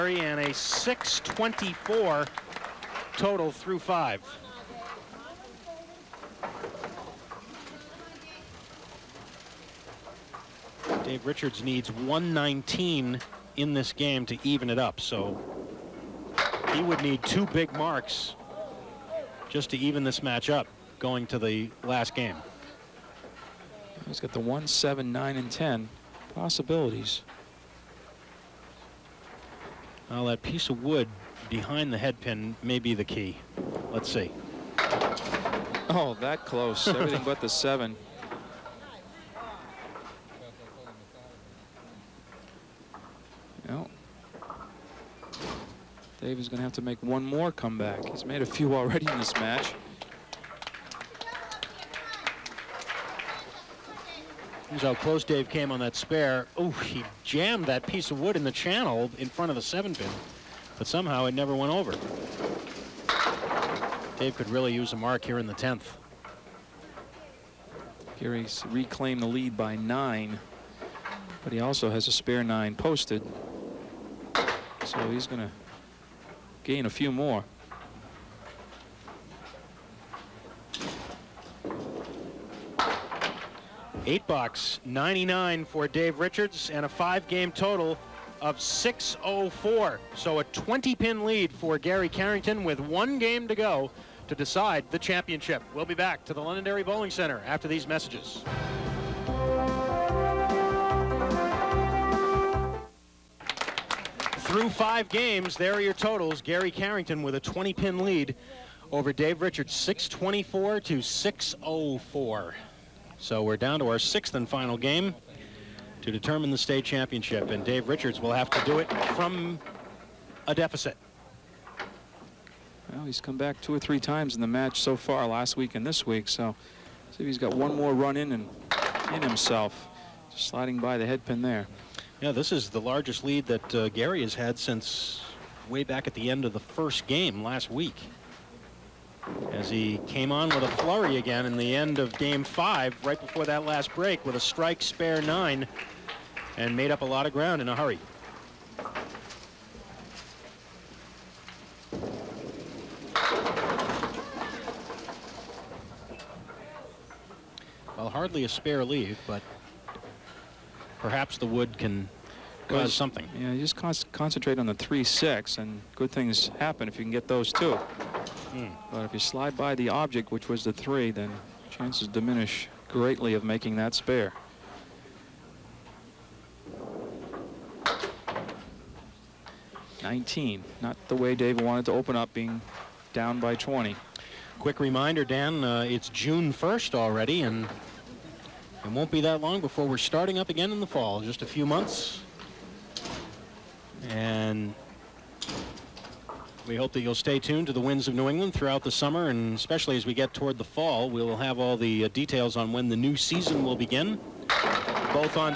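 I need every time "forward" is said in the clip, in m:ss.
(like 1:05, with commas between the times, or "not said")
not said.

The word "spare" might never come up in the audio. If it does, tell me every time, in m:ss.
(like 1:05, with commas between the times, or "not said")
0:55, 1:12, 2:24, 2:38, 2:53.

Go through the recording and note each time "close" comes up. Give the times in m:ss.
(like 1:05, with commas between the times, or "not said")
0:36, 0:54.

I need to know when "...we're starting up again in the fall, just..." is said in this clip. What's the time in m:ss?
3:09.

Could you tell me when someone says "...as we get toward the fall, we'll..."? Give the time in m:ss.
3:19.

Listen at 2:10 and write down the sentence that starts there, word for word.
Just sliding by the head pin there.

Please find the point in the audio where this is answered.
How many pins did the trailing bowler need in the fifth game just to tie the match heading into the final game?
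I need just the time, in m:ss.
0:11.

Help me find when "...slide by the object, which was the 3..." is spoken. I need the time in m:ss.
2:49.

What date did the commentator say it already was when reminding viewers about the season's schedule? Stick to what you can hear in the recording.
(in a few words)
June 1st.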